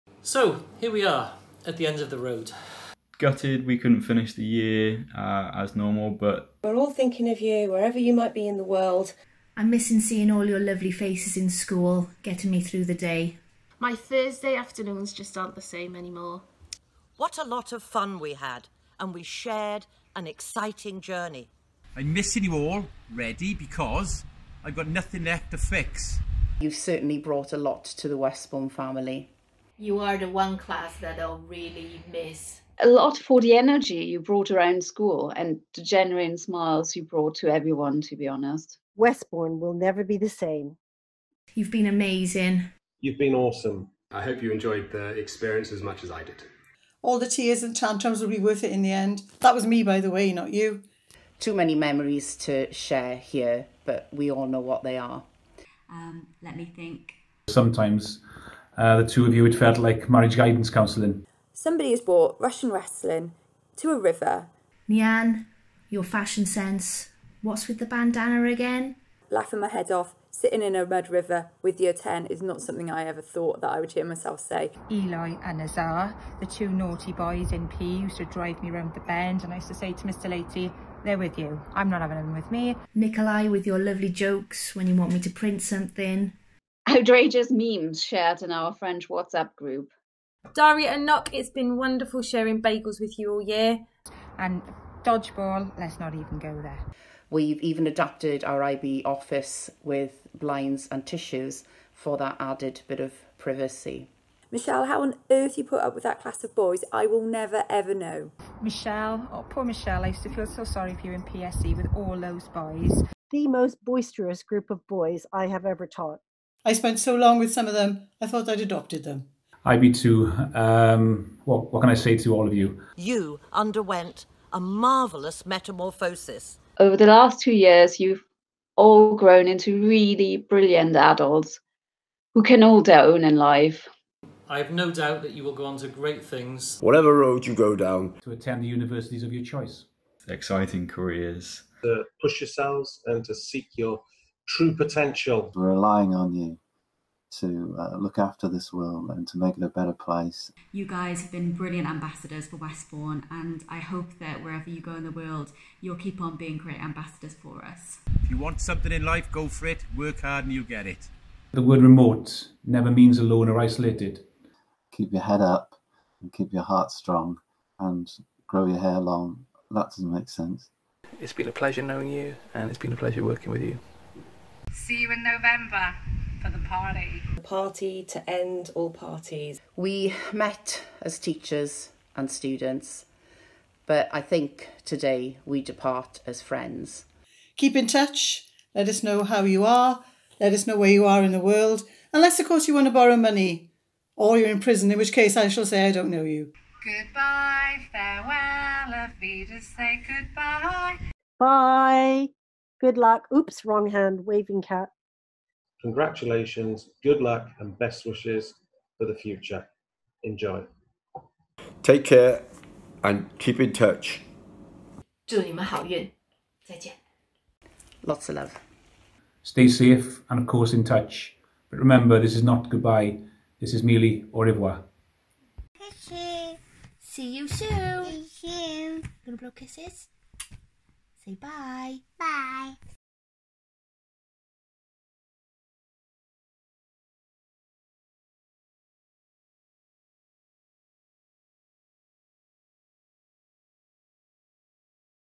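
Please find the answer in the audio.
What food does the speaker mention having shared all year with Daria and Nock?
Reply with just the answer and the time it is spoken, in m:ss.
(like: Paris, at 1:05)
Bagels, at 1:32.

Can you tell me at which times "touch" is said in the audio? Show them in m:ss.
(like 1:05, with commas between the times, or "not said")
3:07, 3:33, 3:40.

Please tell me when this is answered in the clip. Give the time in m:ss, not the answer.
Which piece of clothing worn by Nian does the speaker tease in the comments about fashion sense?
1:07.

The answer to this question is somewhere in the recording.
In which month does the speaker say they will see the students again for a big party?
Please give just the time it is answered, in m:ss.
2:55.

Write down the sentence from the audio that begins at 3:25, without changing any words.
Congratulations, good luck, and best wishes for the future.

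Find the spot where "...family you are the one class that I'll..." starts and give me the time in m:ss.
0:28.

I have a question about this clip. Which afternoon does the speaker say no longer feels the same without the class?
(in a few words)
Thursday.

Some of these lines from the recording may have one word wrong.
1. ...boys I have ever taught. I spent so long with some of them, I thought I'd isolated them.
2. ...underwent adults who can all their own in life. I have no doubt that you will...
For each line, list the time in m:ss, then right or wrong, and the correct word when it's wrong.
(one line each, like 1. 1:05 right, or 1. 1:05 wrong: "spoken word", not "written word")
1. 1:54 wrong: "adopted", not "isolated"
2. 2:10 wrong: "brilliant", not "underwent".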